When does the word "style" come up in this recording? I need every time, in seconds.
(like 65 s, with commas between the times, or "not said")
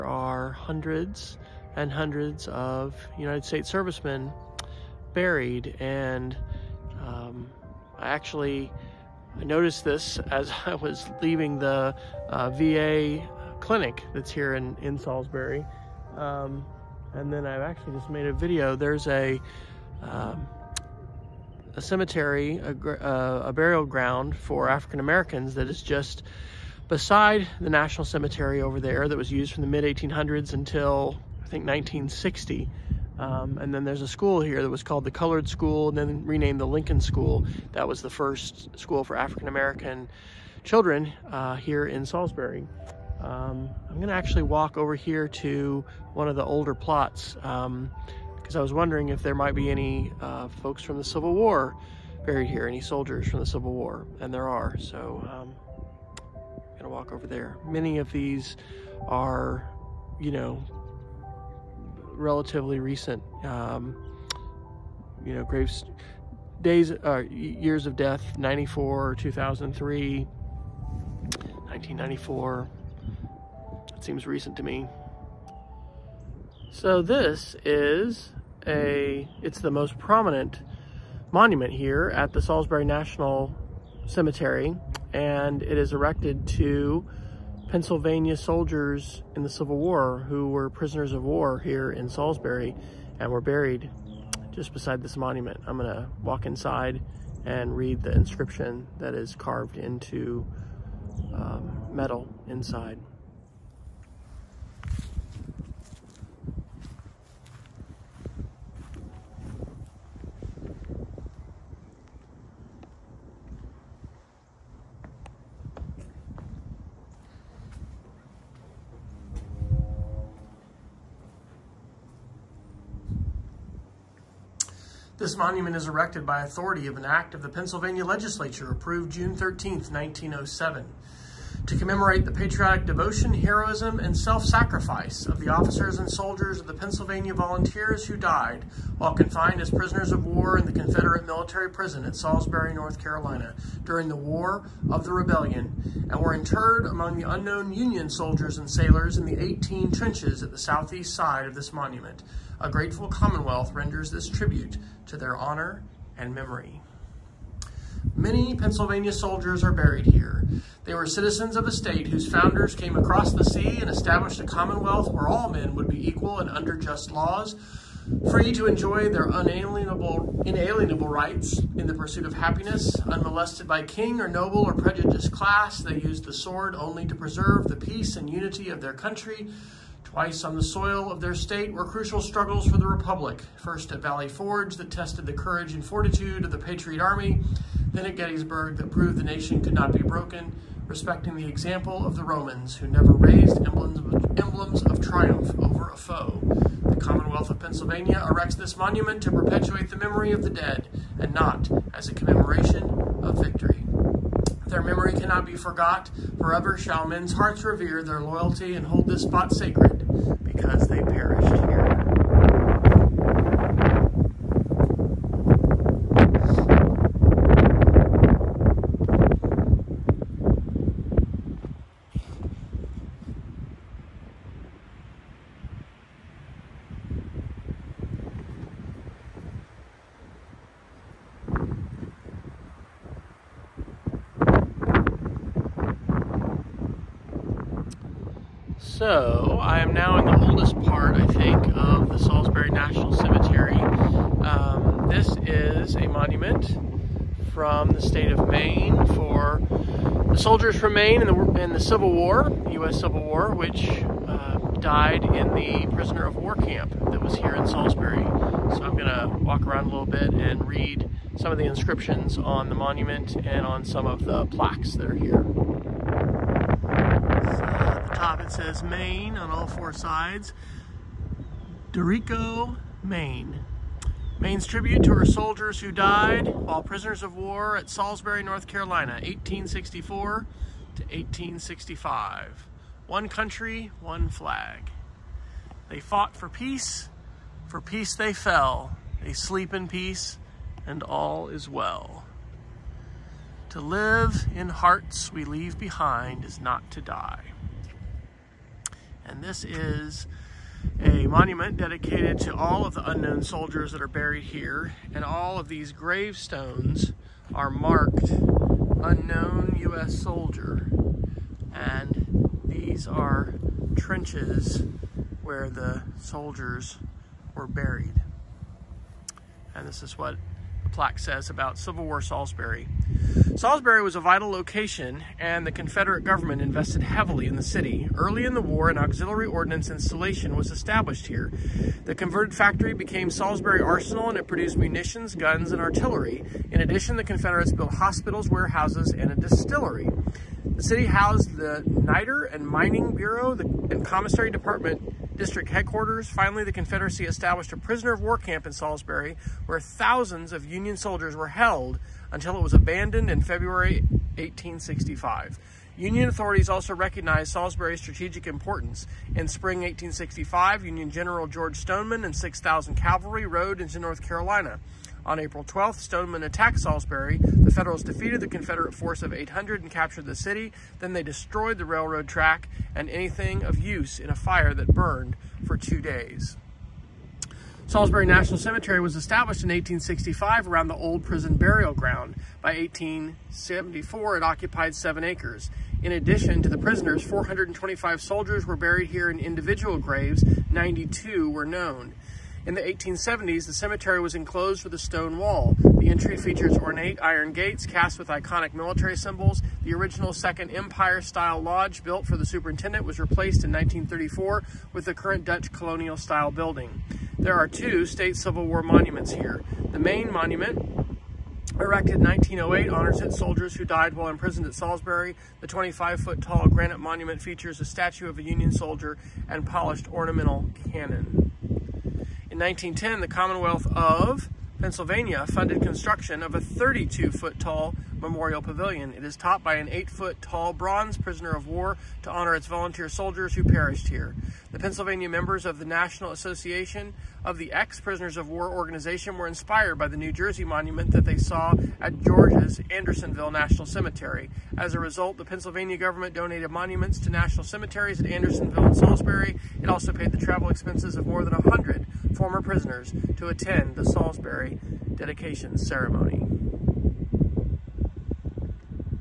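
401 s, 406 s.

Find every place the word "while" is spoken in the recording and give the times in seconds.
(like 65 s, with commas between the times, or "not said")
138 s, 276 s, 414 s.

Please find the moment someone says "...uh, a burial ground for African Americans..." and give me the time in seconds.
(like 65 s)
22 s.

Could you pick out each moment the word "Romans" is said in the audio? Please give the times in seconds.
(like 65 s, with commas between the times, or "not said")
192 s.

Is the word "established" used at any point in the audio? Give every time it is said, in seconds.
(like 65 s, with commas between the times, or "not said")
163 s, 330 s, 347 s, 379 s.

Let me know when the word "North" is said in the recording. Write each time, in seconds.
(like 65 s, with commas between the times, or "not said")
142 s, 278 s, 363 s.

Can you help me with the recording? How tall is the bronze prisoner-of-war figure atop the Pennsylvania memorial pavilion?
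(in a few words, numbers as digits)
8 feet.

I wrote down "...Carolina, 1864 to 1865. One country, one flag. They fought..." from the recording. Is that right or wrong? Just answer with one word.
right.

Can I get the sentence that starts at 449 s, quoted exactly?
It also paid the travel expenses of more than 100 former prisoners to attend the Salisbury dedication ceremony.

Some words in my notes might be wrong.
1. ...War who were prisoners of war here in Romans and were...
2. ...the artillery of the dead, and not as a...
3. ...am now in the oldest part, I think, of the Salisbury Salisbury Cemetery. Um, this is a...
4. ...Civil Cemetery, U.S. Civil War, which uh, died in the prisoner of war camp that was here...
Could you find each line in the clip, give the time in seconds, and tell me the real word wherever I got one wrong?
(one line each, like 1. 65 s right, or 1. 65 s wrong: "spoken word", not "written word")
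1. 89 s wrong: "Salisbury", not "Romans"
2. 199 s wrong: "memory", not "artillery"
3. 239 s wrong: "National", not "Salisbury"
4. 251 s wrong: "War", not "Cemetery".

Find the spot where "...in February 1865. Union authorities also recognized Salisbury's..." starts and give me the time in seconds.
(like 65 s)
353 s.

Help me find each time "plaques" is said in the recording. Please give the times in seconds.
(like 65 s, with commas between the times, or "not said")
264 s, 320 s.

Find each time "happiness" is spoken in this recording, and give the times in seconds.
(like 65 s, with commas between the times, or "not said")
172 s.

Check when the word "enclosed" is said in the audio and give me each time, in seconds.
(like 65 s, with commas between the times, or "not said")
394 s.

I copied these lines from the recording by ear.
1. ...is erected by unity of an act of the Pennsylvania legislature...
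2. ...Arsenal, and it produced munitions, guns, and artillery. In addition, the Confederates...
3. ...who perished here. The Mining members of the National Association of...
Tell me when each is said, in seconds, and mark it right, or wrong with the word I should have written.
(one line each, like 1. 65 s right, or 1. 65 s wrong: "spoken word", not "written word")
1. 125 s wrong: "authority", not "unity"
2. 333 s right
3. 433 s wrong: "Pennsylvania", not "Mining".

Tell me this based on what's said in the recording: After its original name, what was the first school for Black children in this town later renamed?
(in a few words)
Lincoln School.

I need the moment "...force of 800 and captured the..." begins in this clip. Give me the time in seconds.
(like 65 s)
368 s.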